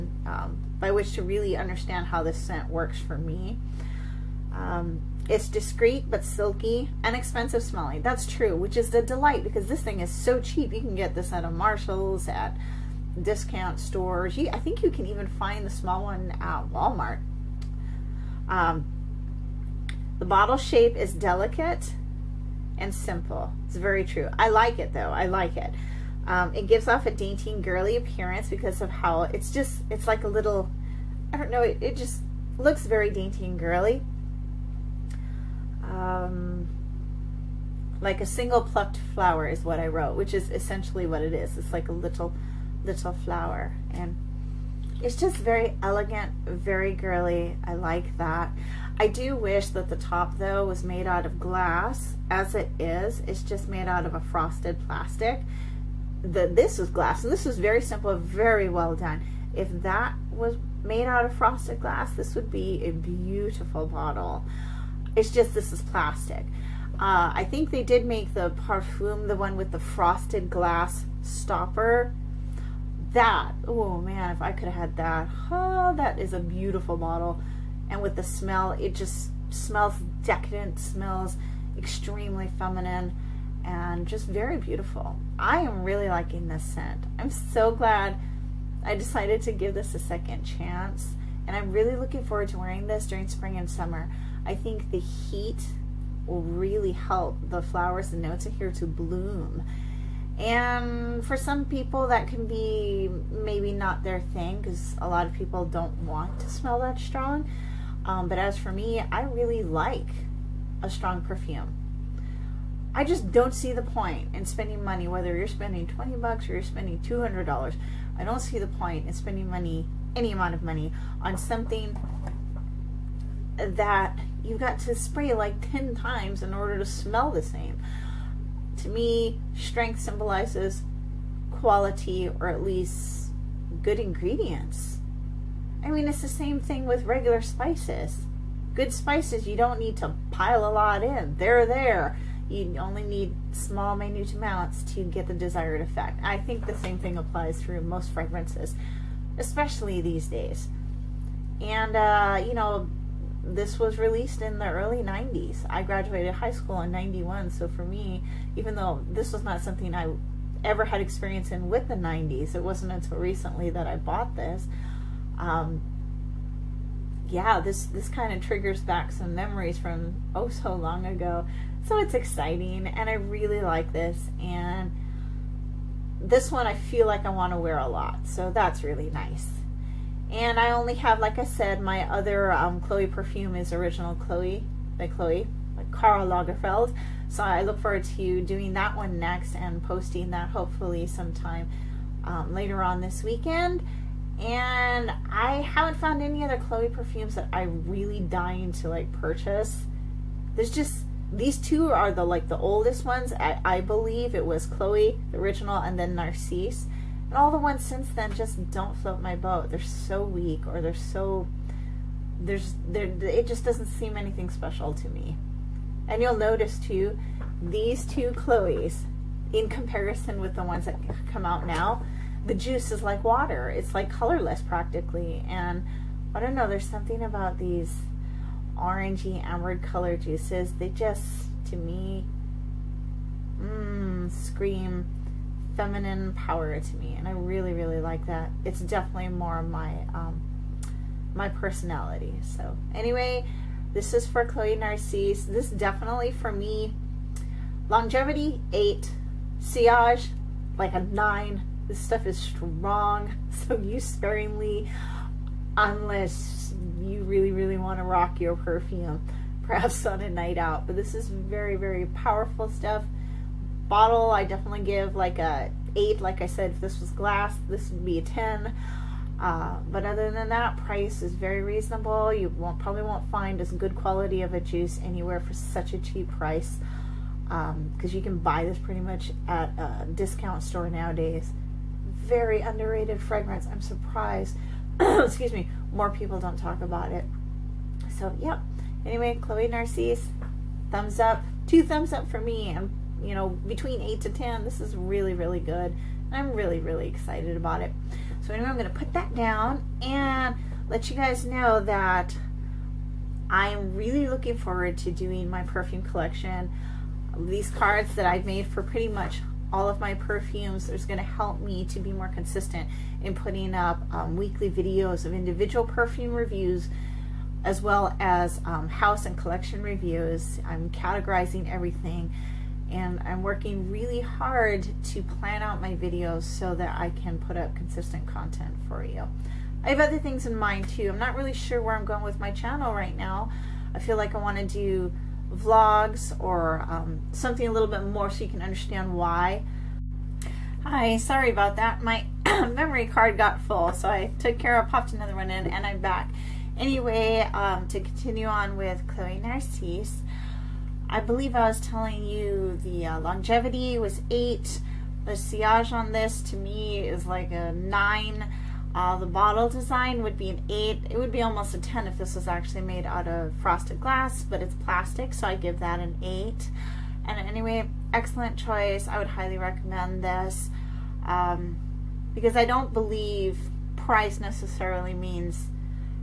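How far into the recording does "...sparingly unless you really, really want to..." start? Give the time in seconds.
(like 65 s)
254 s.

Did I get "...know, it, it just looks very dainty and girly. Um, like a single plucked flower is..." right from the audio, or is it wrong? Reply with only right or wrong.
right.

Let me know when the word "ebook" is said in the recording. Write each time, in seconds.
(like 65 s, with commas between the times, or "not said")
not said.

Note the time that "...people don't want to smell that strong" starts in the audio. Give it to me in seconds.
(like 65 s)
105 s.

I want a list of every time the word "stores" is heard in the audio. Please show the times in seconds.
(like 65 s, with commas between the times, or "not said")
13 s, 280 s.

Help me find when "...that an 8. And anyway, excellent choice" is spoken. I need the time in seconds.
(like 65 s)
365 s.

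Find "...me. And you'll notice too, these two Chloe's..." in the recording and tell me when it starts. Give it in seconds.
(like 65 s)
215 s.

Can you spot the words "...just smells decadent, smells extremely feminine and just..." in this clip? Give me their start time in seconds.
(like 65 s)
78 s.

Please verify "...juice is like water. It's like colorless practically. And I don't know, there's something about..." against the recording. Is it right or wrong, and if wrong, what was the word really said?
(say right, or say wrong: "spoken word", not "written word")
right.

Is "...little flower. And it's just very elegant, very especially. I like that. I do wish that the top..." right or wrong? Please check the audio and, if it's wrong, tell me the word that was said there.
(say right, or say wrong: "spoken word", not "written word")
wrong: "girly", not "especially".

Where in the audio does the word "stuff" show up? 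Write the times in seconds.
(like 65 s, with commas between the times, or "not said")
251 s, 262 s.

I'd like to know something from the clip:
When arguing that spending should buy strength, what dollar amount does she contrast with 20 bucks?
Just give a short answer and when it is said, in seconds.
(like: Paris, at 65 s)
$200, at 116 s.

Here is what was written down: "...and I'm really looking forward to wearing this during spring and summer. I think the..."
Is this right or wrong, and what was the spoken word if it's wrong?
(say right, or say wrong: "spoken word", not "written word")
right.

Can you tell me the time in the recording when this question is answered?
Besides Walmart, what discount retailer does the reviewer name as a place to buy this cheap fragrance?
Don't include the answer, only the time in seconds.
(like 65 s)
11 s.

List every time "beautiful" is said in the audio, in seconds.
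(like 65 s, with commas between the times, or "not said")
62 s, 76 s, 84 s.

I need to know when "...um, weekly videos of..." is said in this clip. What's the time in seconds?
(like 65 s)
314 s.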